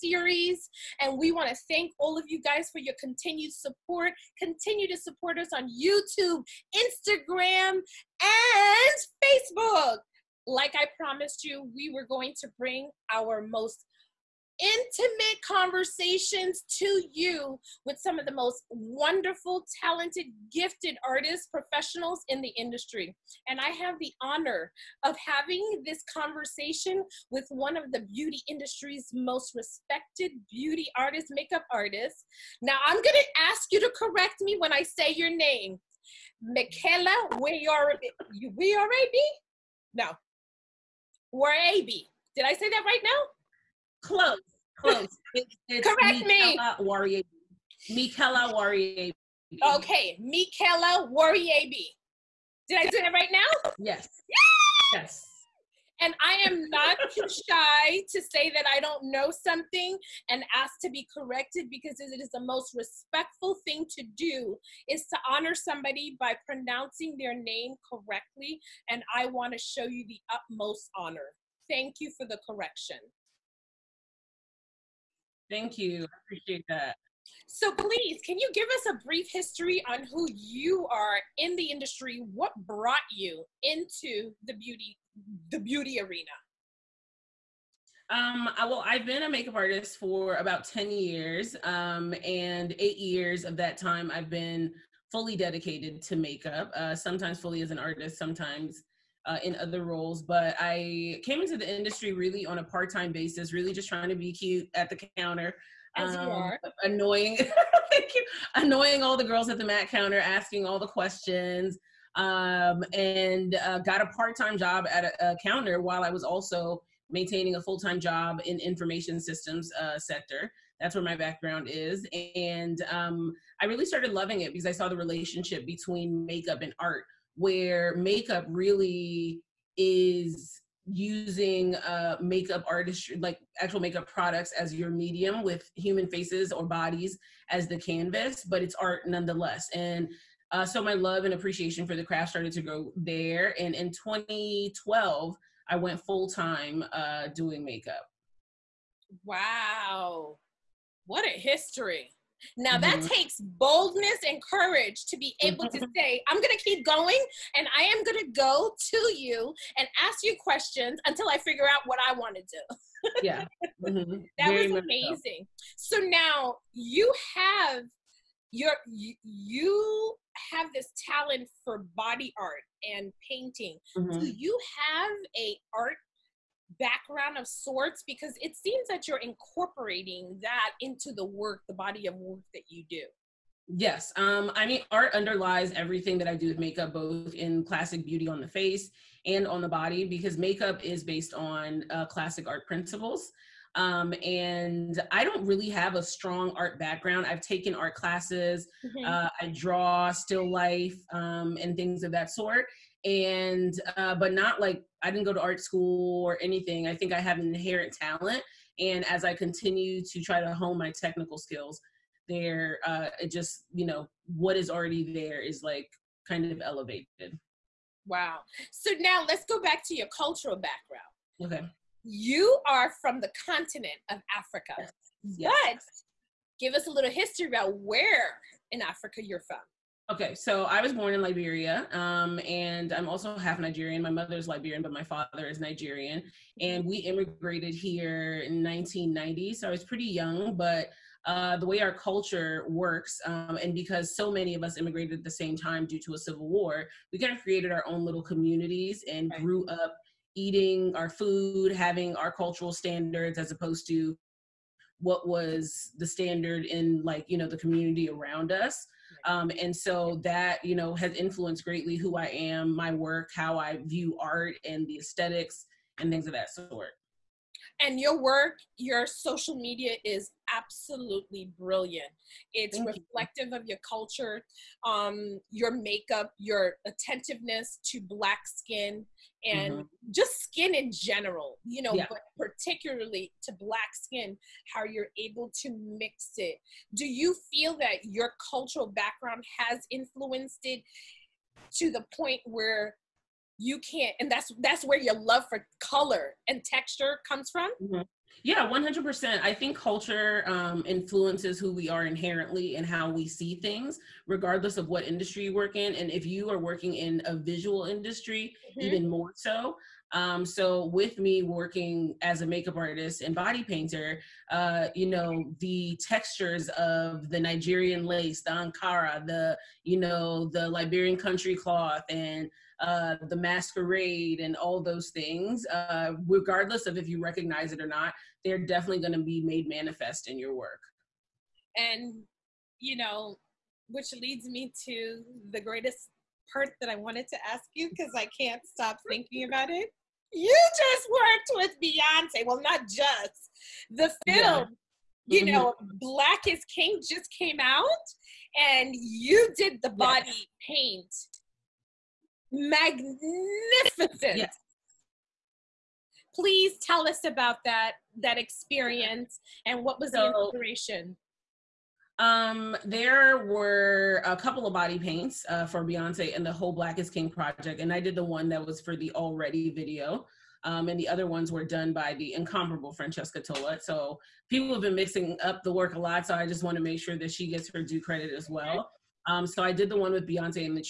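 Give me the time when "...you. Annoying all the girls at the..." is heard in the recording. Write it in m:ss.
1:48.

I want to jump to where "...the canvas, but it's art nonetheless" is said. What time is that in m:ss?
2:17.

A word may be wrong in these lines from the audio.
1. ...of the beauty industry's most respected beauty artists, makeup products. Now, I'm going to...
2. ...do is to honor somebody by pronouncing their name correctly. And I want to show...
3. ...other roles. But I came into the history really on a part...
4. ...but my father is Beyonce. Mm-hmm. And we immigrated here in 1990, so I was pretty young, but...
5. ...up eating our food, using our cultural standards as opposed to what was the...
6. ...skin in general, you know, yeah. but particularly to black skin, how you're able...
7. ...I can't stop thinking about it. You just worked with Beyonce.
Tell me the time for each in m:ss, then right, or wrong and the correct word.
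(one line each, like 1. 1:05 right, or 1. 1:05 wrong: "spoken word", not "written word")
1. 0:27 wrong: "artists", not "products"
2. 1:04 right
3. 1:39 wrong: "industry", not "history"
4. 3:54 wrong: "Nigerian", not "Beyonce"
5. 4:09 wrong: "having", not "using"
6. 4:40 right
7. 5:38 right.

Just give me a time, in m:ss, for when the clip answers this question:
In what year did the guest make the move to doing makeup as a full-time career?
2:23.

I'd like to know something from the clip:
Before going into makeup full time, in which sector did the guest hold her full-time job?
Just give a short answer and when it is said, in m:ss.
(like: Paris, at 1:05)
Information systems, at 1:58.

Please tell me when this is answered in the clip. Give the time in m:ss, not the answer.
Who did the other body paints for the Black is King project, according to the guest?
6:12.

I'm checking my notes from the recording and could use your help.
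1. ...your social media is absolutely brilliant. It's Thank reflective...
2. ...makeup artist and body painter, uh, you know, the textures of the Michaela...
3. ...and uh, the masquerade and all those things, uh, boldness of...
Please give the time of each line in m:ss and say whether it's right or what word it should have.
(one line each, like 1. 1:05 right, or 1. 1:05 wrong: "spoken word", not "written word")
1. 4:28 right
2. 5:12 wrong: "Nigerian", not "Michaela"
3. 5:22 wrong: "regardless", not "boldness".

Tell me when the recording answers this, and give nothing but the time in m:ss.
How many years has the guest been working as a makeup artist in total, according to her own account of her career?
1:30.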